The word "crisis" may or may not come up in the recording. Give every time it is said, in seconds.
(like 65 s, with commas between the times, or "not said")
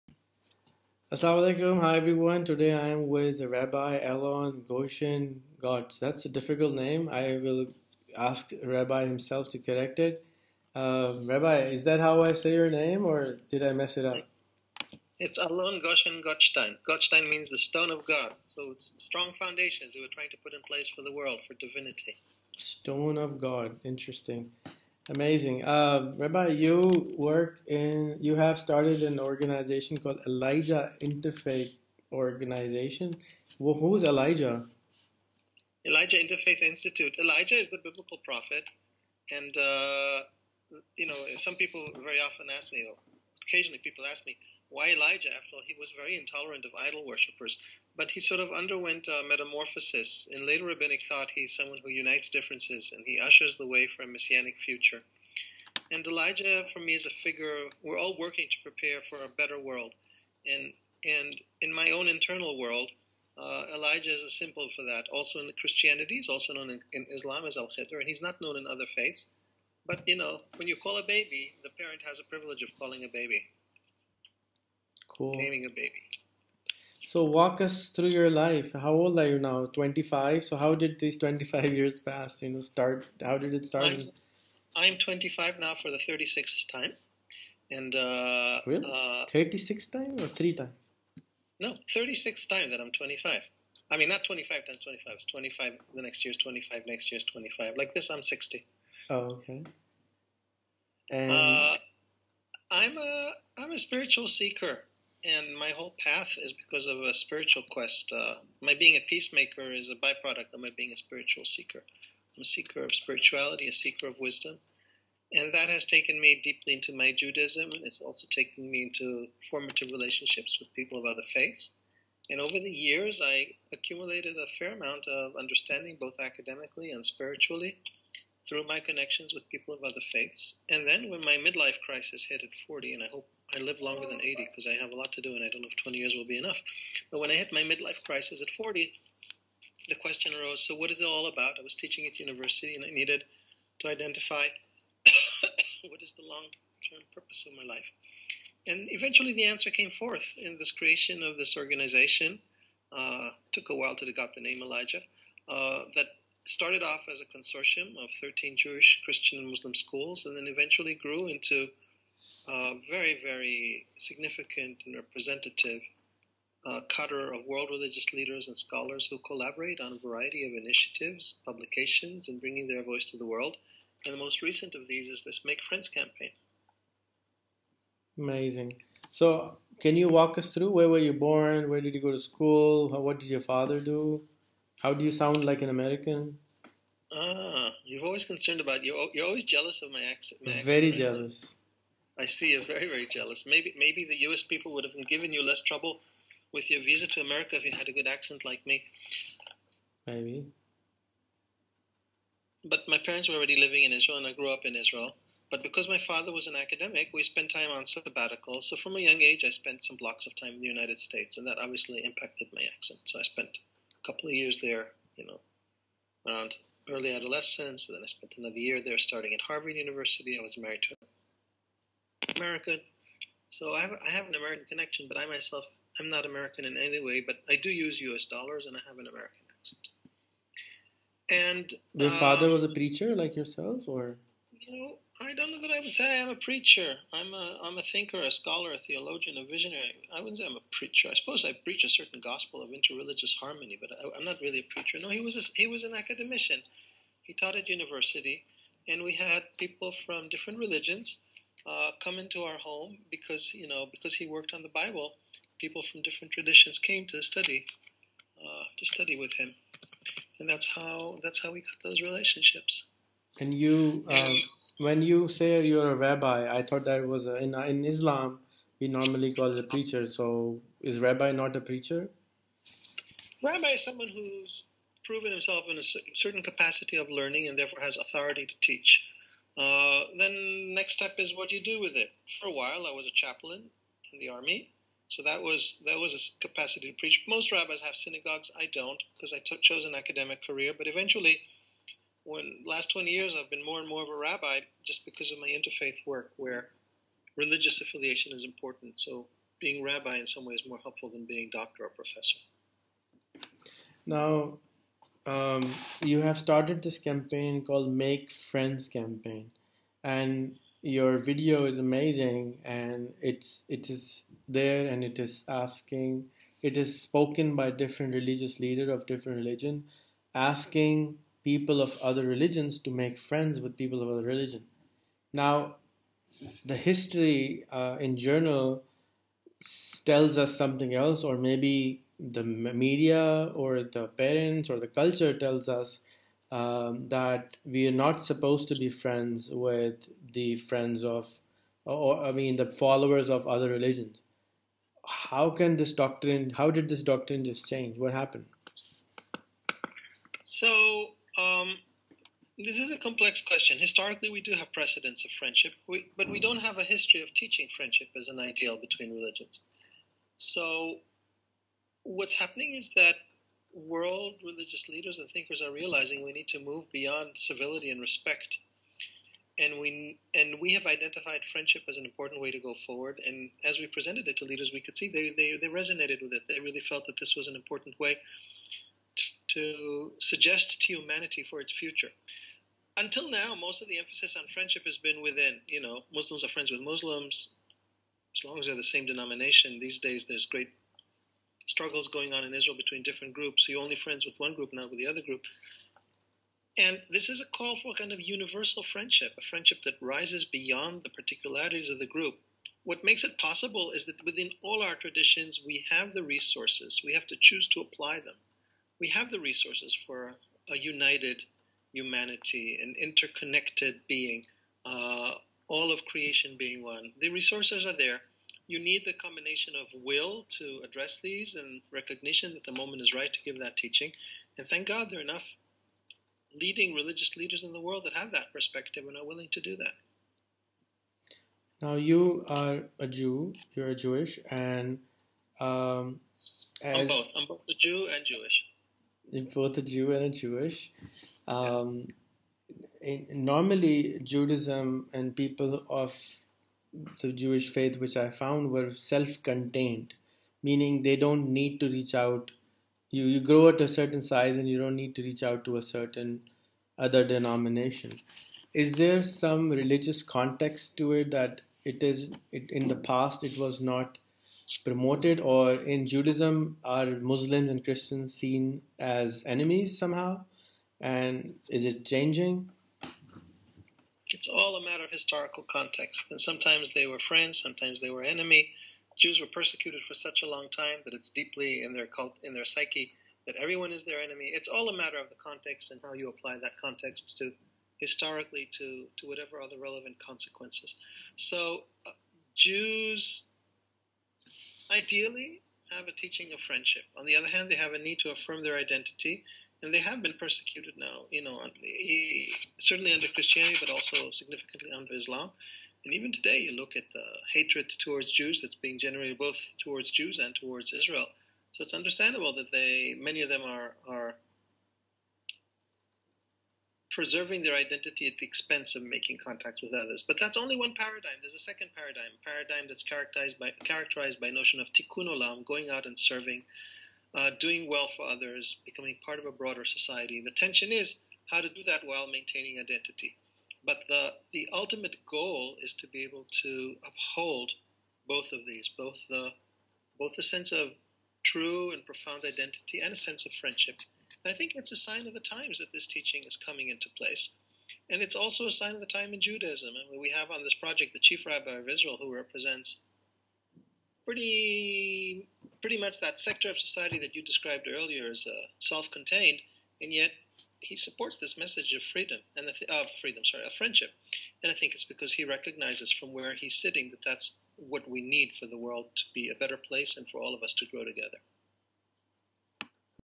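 131 s, 138 s.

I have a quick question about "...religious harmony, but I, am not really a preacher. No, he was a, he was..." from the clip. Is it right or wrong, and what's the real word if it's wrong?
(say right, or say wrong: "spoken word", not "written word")
wrong: "interreligious", not "religious".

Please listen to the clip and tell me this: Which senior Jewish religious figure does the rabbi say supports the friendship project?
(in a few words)
Chief rabbi of Israel.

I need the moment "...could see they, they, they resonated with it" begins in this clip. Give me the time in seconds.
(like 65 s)
374 s.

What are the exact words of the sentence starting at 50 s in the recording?
In later rabbinic thought, he's someone who unites differences and he ushers the way for a messianic future.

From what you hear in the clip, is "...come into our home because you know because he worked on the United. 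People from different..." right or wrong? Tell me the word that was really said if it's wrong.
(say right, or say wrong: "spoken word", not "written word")
wrong: "Bible", not "United".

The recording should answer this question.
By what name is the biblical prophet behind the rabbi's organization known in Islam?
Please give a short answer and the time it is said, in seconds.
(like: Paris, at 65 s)
Al Khidr, at 67 s.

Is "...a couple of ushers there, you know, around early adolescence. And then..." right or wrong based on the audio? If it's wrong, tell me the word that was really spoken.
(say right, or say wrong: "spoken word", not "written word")
wrong: "years", not "ushers".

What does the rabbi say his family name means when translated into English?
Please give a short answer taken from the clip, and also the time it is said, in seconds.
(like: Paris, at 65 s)
The stone of God, at 17 s.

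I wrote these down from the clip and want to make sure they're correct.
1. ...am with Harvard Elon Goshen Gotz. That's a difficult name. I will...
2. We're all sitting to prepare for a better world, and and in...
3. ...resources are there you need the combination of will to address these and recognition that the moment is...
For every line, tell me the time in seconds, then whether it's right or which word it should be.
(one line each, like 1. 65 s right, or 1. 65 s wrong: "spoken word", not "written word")
1. 2 s wrong: "Rabbi", not "Harvard"
2. 57 s wrong: "working", not "sitting"
3. 417 s right.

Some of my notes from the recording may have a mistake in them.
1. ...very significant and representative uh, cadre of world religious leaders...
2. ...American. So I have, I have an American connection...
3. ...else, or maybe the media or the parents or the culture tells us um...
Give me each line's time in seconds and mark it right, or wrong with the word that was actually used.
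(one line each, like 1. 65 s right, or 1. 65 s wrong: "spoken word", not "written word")
1. 163 s right
2. 222 s right
3. 330 s right.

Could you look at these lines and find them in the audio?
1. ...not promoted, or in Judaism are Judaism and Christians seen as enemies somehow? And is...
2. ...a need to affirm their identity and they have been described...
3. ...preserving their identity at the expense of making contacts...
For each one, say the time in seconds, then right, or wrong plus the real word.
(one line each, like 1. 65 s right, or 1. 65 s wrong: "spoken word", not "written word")
1. 463 s wrong: "Muslims", not "Judaism"
2. 497 s wrong: "persecuted", not "described"
3. 517 s right.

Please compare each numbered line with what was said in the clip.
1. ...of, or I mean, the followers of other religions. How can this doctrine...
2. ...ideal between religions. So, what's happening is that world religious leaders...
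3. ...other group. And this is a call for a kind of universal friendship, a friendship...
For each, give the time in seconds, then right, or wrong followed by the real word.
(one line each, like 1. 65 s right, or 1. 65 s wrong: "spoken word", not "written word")
1. 341 s right
2. 358 s right
3. 395 s right.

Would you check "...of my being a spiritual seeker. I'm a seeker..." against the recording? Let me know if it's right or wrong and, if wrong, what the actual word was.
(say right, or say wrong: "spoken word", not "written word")
right.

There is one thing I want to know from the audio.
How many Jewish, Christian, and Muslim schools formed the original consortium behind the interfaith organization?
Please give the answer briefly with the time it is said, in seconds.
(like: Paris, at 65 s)
13, at 158 s.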